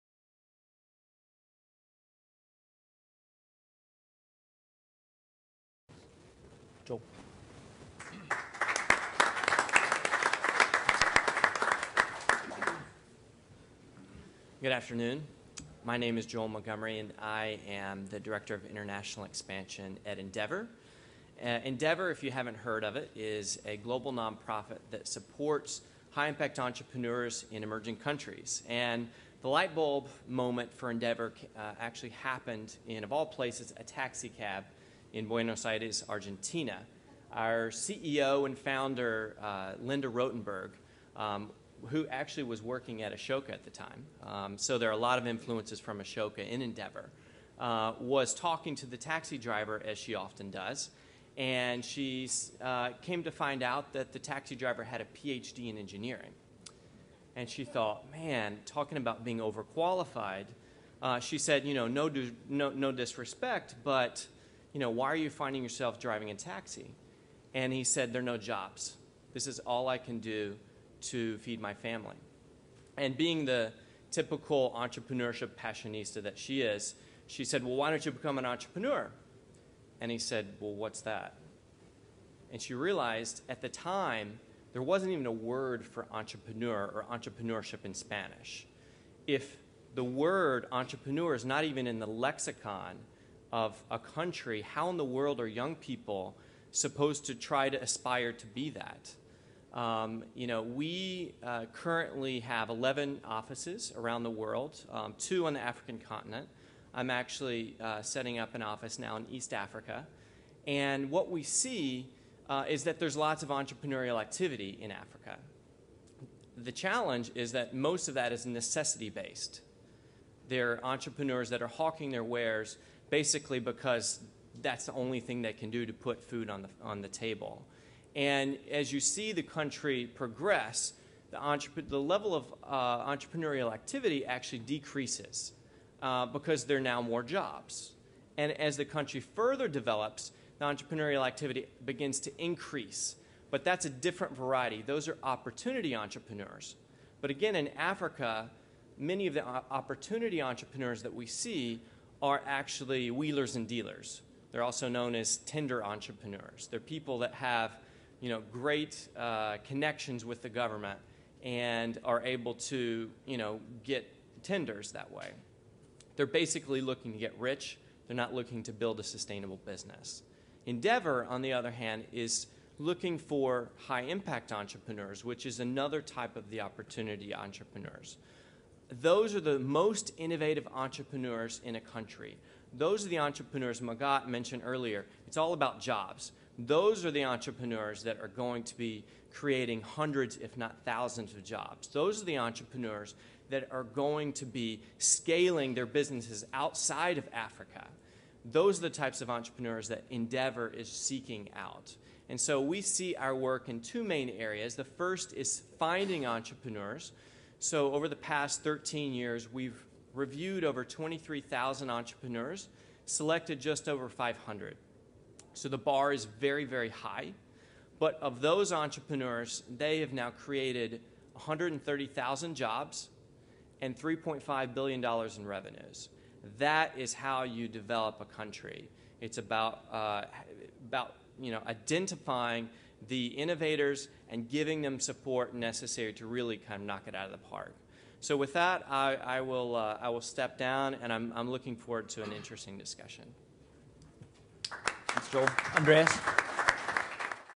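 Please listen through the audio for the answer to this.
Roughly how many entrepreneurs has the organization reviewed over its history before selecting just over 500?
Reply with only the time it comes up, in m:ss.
3:30.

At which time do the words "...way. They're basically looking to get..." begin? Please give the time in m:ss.
2:45.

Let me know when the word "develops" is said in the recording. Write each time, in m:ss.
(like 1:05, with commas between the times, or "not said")
2:19, 3:47.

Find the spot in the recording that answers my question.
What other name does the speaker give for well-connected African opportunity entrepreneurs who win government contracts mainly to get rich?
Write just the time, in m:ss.
2:35.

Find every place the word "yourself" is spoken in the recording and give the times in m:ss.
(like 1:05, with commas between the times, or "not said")
1:05.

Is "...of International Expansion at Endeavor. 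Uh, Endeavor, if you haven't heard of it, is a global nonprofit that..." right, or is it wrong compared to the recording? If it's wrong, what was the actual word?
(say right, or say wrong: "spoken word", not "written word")
right.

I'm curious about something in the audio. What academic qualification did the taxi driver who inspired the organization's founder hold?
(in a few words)
PhD in engineering.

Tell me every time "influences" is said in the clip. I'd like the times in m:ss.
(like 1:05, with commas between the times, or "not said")
0:45.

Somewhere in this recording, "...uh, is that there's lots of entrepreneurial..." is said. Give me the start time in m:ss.
1:52.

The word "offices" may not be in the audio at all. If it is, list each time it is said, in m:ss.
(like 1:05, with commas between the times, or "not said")
1:43, 1:48.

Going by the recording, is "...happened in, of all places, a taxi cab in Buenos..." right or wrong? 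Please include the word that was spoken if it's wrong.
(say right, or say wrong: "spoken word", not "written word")
right.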